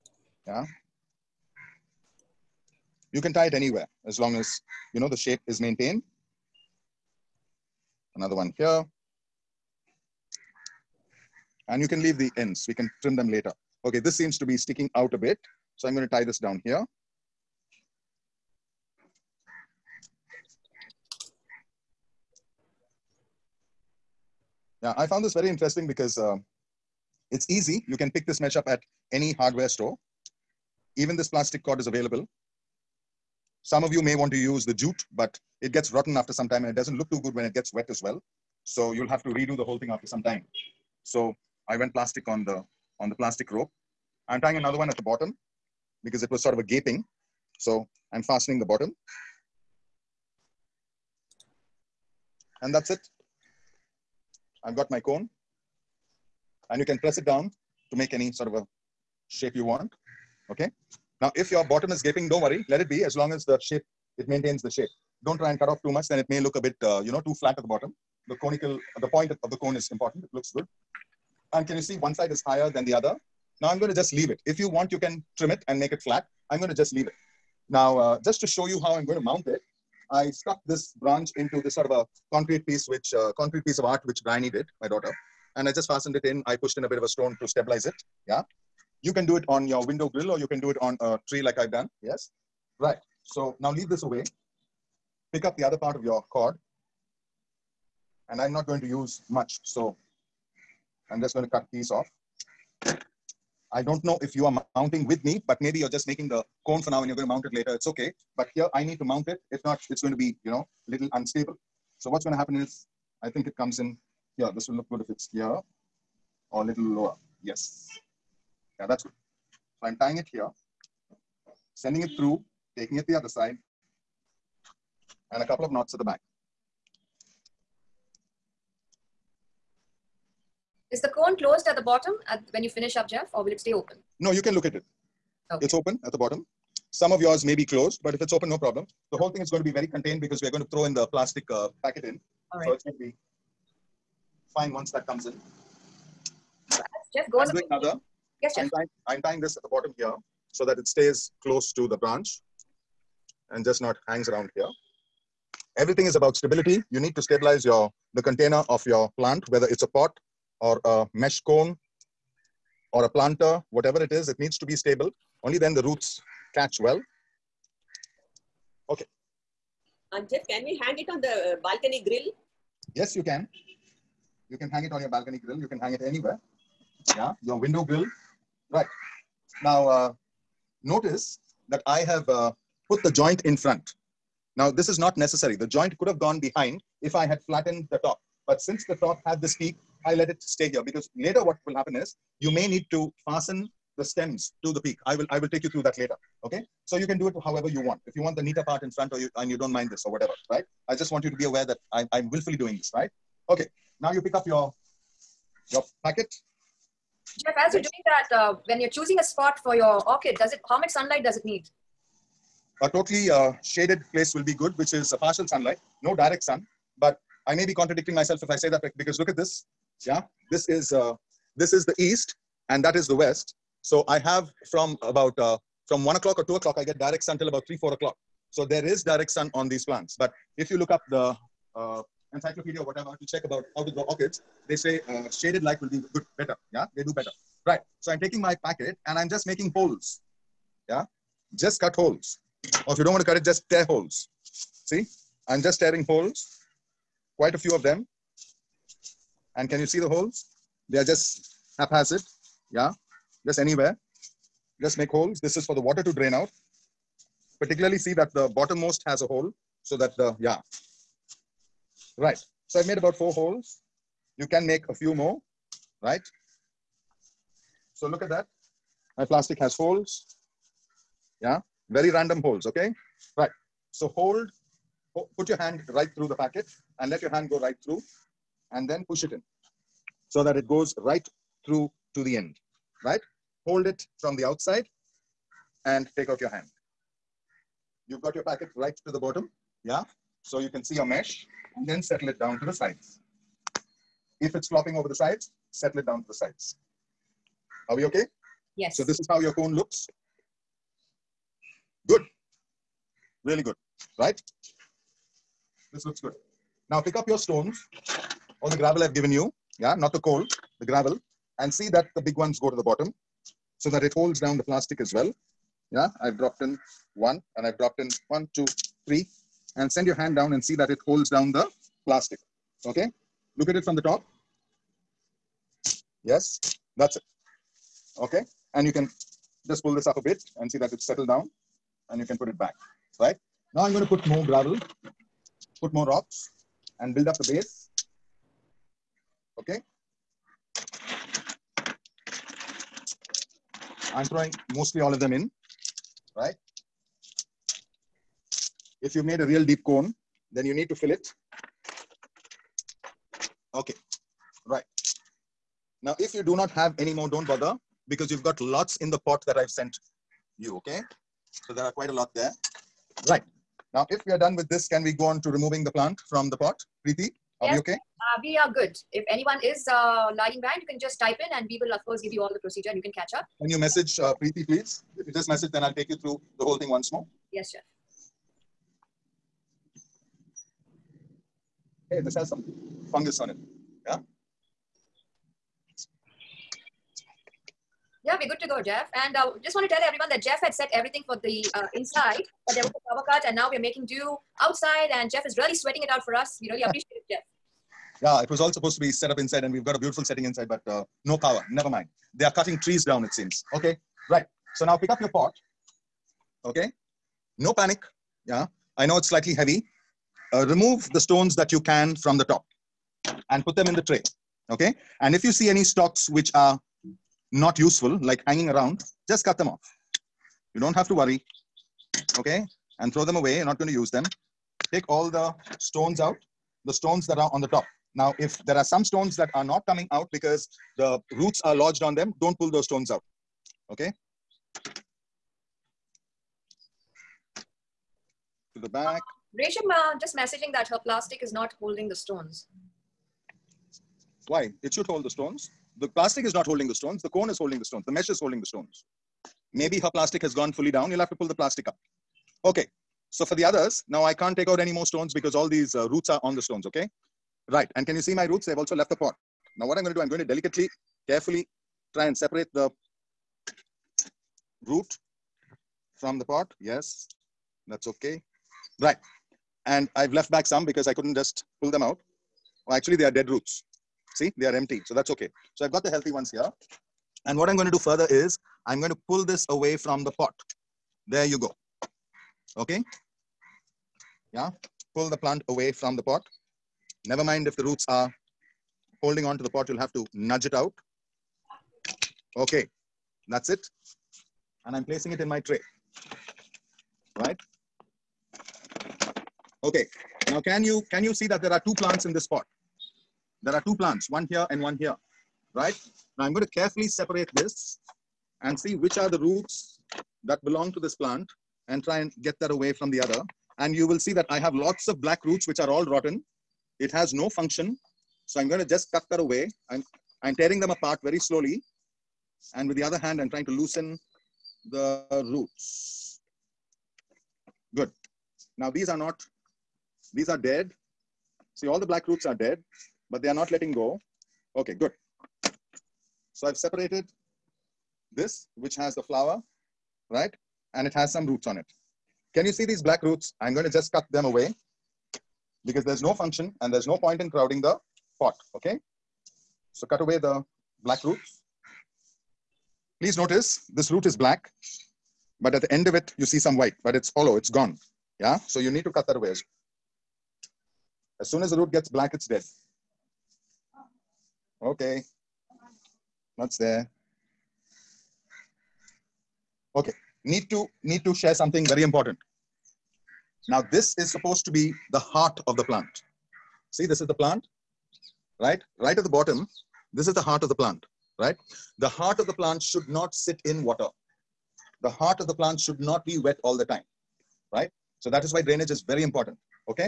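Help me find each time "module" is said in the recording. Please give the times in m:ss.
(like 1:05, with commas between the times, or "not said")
not said.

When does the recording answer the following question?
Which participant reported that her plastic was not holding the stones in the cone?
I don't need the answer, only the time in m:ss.
7:19.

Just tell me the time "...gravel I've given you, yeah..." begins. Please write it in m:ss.
5:08.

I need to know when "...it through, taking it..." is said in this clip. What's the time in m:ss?
2:02.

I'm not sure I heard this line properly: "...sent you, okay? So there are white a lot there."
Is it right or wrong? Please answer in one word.
wrong.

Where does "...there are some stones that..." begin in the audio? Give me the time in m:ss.
7:08.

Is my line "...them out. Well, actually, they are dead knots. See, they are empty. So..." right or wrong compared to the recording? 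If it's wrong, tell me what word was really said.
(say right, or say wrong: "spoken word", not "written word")
wrong: "roots", not "knots".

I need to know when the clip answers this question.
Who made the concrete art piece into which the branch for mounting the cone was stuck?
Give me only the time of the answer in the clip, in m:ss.
1:24.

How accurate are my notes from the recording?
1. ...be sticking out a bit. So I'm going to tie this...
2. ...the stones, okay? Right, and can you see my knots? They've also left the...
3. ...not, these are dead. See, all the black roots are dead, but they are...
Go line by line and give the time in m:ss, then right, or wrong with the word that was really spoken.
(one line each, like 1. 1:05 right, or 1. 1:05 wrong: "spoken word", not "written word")
1. 0:14 right
2. 7:36 wrong: "roots", not "knots"
3. 8:49 right.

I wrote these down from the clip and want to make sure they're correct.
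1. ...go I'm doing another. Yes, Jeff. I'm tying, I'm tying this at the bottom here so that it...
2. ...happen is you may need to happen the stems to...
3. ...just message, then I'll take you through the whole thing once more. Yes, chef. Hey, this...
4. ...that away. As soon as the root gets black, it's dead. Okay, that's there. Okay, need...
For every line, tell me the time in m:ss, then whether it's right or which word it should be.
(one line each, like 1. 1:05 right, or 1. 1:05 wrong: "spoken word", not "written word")
1. 2:27 right
2. 3:11 wrong: "fasten", not "happen"
3. 6:15 right
4. 9:19 right.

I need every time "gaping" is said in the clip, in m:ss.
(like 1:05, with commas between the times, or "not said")
0:46, 1:02.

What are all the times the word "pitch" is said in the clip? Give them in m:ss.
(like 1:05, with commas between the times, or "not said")
not said.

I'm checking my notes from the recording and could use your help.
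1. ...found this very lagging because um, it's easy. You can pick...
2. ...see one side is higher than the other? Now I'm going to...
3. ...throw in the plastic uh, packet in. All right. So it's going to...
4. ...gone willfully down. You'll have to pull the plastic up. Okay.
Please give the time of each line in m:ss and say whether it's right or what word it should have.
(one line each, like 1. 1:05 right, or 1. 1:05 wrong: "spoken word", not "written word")
1. 0:25 wrong: "interesting", not "lagging"
2. 1:11 right
3. 2:20 right
4. 7:30 wrong: "fully", not "willfully".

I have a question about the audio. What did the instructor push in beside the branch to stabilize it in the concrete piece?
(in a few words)
a stone.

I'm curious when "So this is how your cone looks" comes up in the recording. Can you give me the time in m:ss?
4:58.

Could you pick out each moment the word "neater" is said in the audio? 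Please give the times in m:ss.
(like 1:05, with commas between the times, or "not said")
3:18.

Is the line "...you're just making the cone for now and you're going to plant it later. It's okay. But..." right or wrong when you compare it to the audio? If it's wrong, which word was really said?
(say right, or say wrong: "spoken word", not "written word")
wrong: "mount", not "plant".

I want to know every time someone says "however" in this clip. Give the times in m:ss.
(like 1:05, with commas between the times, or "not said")
3:17.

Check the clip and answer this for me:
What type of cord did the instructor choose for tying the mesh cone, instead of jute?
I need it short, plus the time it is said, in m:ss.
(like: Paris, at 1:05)
plastic rope, at 0:43.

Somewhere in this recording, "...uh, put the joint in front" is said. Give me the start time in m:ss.
3:02.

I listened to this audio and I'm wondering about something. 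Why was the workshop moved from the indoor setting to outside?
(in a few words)
power cut.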